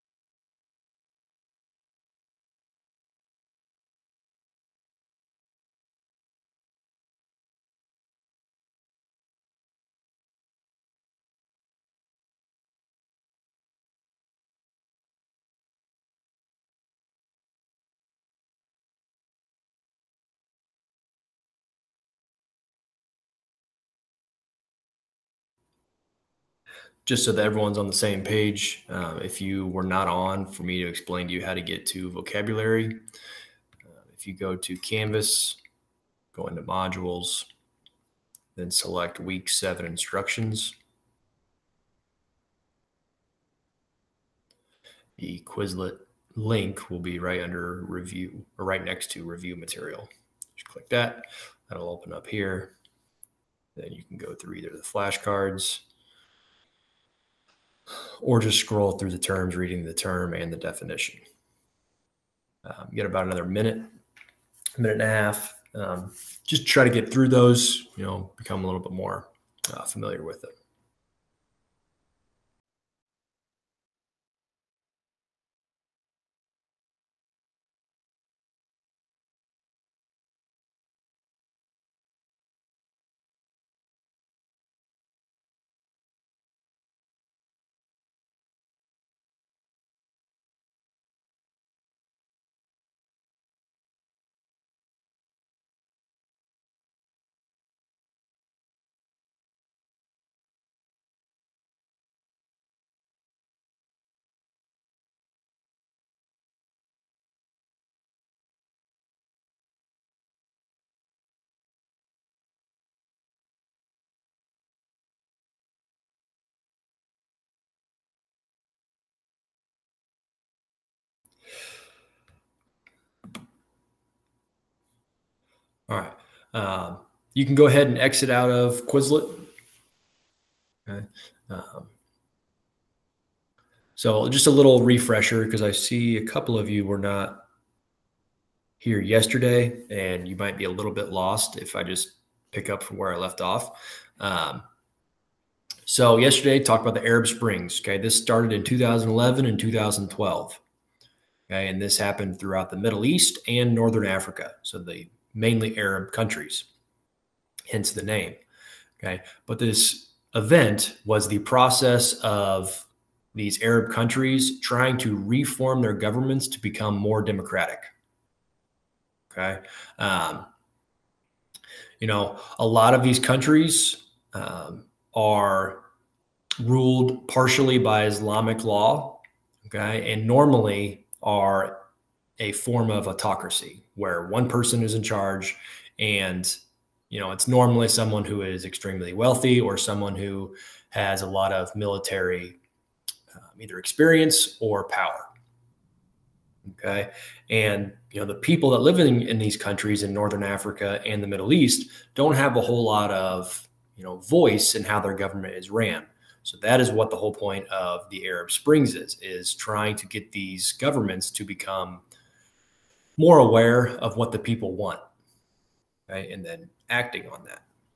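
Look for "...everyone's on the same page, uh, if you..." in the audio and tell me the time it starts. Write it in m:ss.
0:27.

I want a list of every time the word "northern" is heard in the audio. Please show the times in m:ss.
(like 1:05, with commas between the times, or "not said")
2:33, 3:20.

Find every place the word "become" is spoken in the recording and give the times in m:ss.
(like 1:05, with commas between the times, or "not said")
1:08, 2:46, 3:31.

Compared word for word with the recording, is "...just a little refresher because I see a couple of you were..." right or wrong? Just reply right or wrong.
right.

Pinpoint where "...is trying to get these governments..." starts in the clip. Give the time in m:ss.
3:29.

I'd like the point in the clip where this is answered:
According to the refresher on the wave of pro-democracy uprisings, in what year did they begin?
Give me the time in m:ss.
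2:28.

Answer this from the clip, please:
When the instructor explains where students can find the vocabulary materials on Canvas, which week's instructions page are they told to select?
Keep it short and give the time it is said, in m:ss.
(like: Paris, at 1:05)
week 7, at 0:39.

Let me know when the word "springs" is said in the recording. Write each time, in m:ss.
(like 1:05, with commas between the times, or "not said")
2:27, 3:28.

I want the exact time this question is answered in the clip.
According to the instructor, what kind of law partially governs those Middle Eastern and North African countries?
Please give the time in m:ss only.
2:58.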